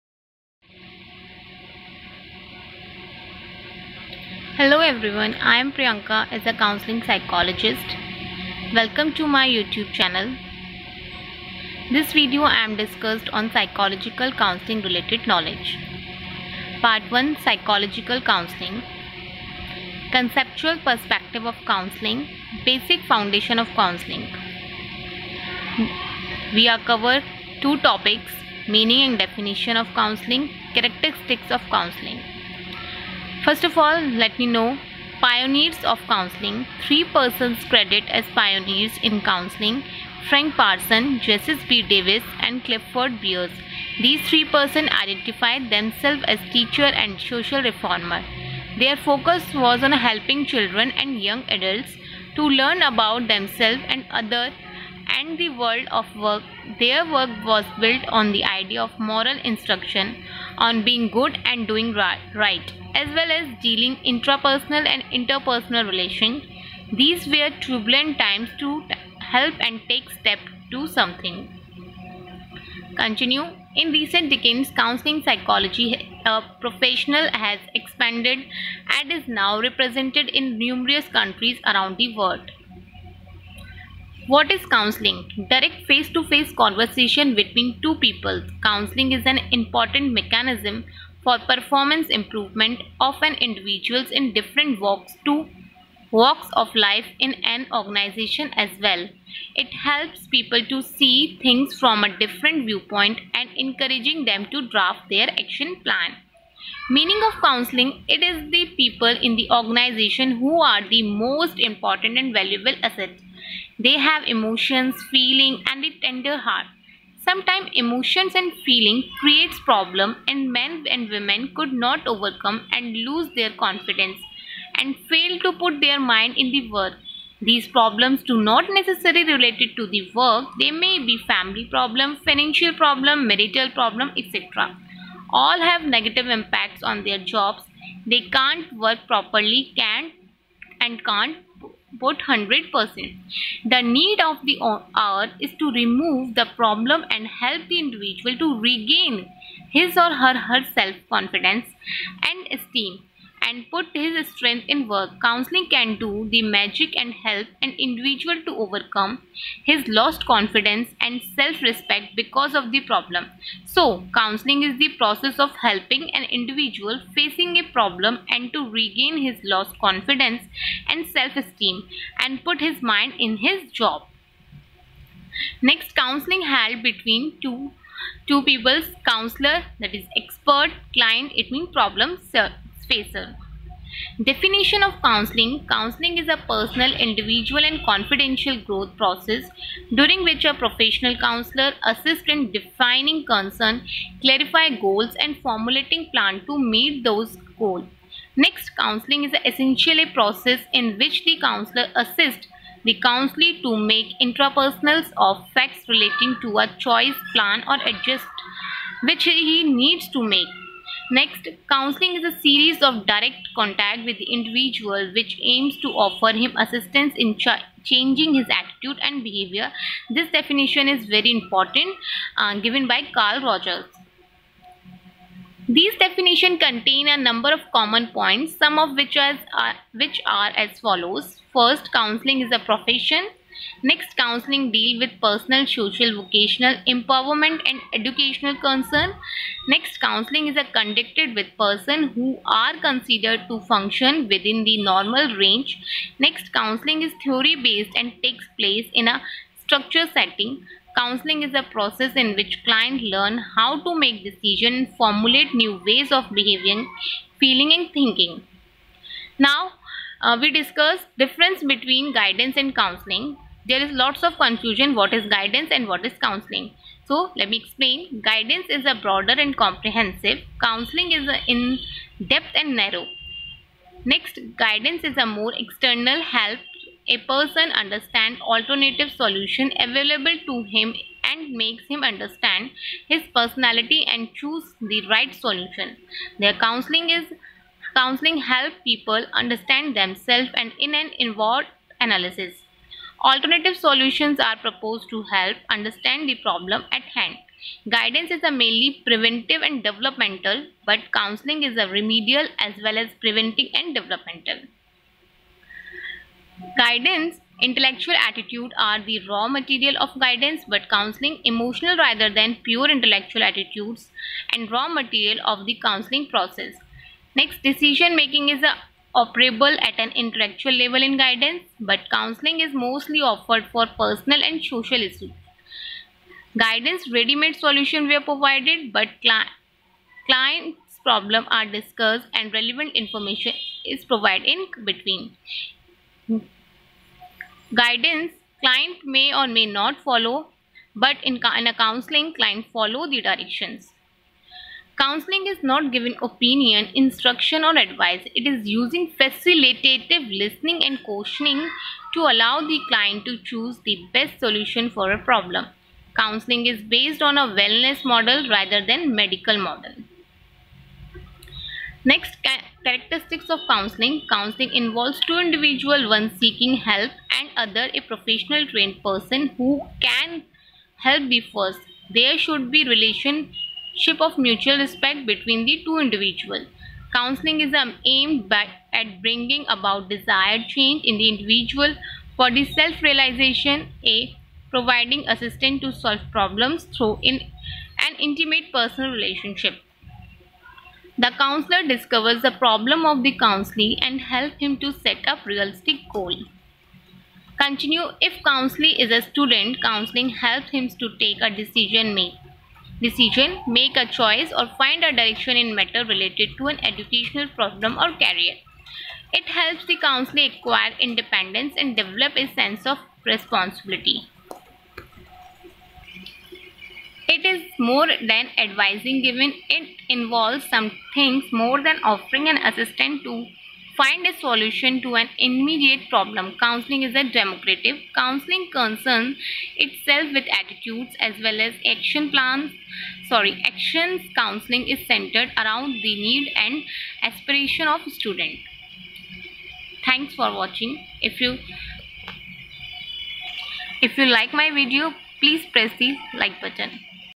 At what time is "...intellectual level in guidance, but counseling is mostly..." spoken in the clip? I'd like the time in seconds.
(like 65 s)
320 s.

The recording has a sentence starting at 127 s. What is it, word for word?
These problems do not necessarily related to the work.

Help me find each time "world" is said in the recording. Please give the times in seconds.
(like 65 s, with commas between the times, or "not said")
55 s, 82 s.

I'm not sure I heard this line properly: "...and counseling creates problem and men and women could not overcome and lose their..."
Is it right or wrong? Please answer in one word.
wrong.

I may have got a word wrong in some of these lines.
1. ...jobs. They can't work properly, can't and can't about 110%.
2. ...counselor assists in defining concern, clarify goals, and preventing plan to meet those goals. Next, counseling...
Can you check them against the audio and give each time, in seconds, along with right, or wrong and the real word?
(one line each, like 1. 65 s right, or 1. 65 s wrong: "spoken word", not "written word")
1. 137 s wrong: "100", not "110"
2. 191 s wrong: "formulating", not "preventing".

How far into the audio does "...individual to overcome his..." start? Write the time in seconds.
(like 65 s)
157 s.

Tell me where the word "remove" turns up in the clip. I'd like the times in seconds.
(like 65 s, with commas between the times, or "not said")
145 s.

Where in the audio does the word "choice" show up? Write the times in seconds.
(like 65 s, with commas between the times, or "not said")
206 s, 404 s.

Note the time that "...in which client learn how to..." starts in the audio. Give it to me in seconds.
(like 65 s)
252 s.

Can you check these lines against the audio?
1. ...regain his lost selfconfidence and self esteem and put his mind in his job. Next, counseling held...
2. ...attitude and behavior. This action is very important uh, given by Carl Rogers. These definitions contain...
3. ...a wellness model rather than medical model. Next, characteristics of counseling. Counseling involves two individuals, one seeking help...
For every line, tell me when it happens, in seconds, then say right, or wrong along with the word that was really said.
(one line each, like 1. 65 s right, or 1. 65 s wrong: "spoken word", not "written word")
1. 168 s wrong: "confidence", not "selfconfidence"
2. 218 s wrong: "definition", not "action"
3. 357 s right.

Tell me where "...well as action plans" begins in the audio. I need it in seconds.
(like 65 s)
431 s.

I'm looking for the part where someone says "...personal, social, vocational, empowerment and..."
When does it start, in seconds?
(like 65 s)
235 s.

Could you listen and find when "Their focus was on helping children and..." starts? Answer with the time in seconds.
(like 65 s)
48 s.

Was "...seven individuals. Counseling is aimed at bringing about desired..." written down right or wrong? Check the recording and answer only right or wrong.
wrong.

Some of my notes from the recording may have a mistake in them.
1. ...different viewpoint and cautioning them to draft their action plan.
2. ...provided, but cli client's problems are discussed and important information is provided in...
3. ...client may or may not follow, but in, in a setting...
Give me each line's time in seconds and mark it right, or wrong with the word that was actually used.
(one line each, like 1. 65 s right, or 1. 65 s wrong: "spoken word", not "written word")
1. 102 s wrong: "encouraging", not "cautioning"
2. 328 s wrong: "relevant", not "important"
3. 338 s wrong: "counseling", not "setting".